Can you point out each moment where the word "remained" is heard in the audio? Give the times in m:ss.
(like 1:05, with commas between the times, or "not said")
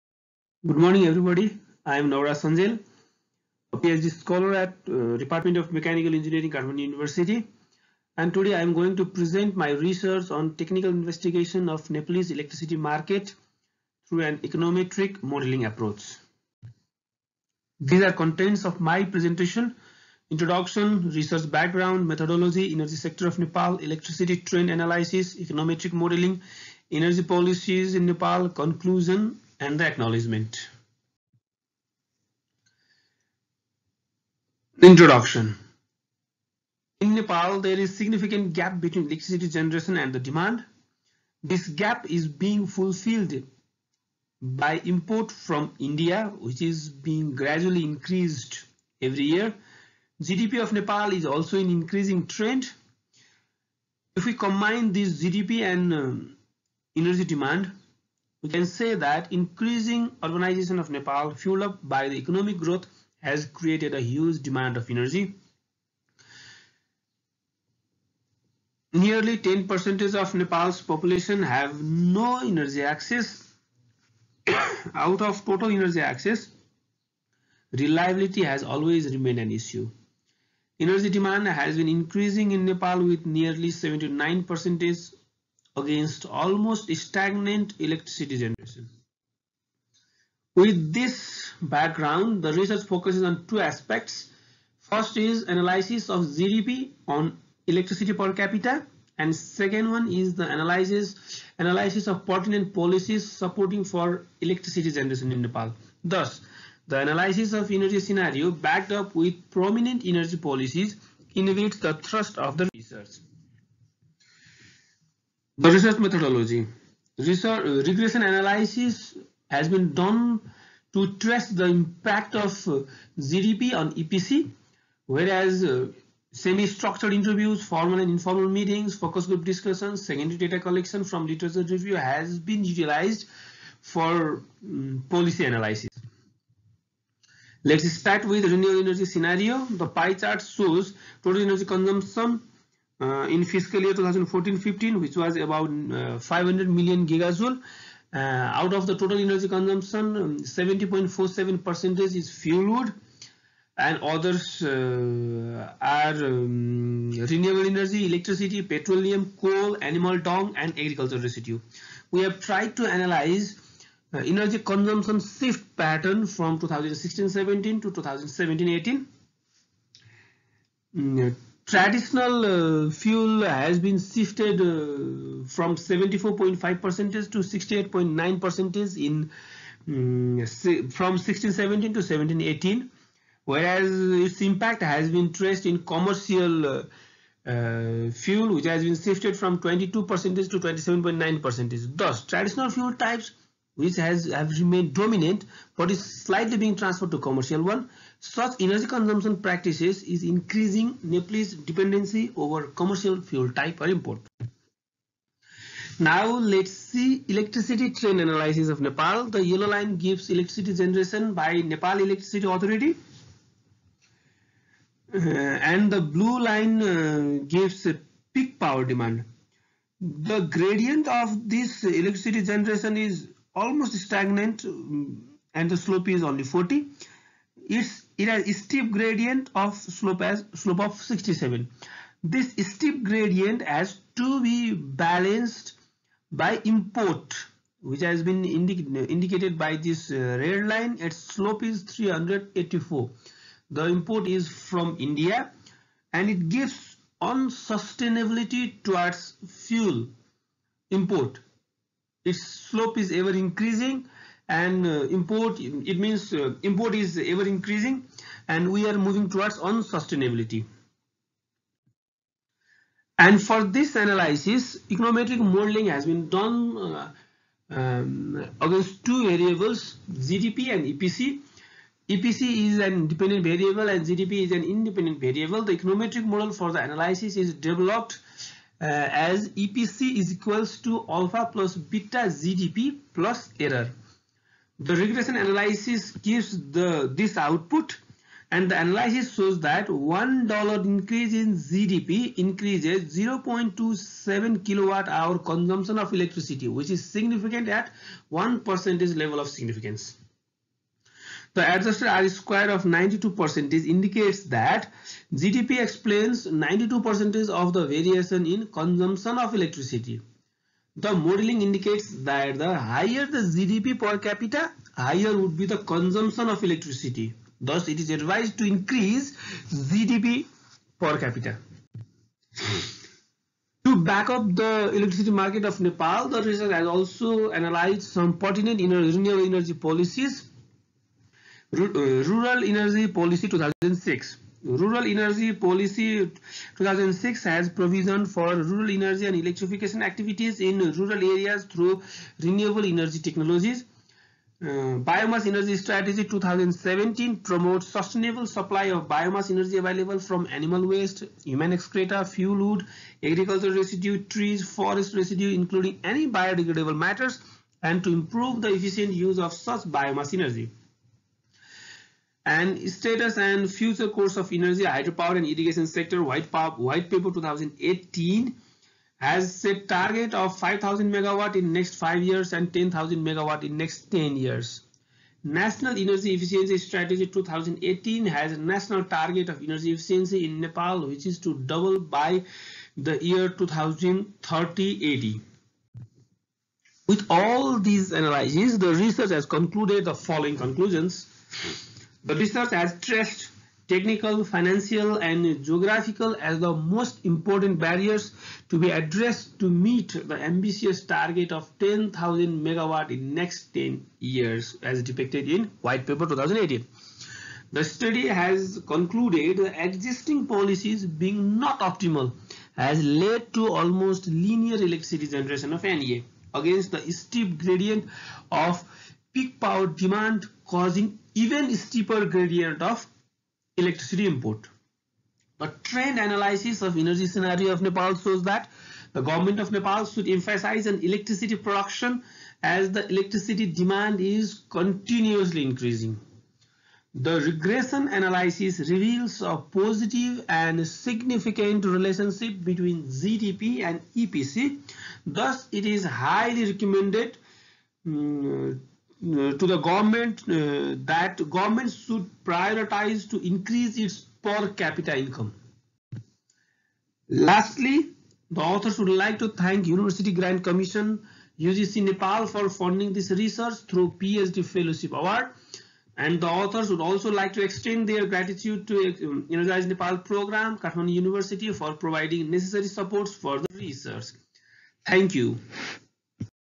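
1:19, 3:14.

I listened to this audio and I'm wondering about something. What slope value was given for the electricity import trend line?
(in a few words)
384.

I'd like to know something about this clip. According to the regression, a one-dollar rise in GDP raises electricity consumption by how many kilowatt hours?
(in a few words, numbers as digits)
0.27.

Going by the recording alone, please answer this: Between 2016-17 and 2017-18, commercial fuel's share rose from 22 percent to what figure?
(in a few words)
27.9%.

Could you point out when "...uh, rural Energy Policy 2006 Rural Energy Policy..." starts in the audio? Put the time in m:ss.
5:31.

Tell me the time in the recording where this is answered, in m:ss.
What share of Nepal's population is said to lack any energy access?
1:08.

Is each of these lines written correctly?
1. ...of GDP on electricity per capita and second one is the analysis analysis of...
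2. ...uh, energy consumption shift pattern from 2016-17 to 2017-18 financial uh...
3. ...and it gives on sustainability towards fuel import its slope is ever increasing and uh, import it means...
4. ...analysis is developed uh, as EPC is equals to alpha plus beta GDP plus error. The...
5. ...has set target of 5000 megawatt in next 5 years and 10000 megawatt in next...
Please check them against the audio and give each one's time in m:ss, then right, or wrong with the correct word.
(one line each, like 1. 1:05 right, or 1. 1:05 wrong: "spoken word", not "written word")
1. 1:36 right
2. 2:44 wrong: "traditional", not "financial"
3. 4:06 right
4. 4:36 right
5. 6:09 right.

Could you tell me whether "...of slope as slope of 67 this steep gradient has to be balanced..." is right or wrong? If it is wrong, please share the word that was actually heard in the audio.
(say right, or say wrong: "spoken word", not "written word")
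right.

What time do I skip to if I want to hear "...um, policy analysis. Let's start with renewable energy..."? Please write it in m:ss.
2:14.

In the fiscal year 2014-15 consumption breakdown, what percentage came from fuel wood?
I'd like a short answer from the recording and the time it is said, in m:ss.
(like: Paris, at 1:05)
70.47%, at 2:30.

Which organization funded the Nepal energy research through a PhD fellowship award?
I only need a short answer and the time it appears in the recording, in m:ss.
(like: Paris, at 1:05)
University Grant Commission, at 7:39.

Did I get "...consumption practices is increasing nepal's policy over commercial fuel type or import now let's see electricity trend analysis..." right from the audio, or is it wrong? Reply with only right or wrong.
wrong.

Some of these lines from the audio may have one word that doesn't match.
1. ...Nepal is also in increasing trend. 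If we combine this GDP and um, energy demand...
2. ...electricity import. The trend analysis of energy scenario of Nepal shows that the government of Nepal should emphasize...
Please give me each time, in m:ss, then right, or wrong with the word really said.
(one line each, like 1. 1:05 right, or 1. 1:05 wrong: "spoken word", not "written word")
1. 0:50 right
2. 7:03 right.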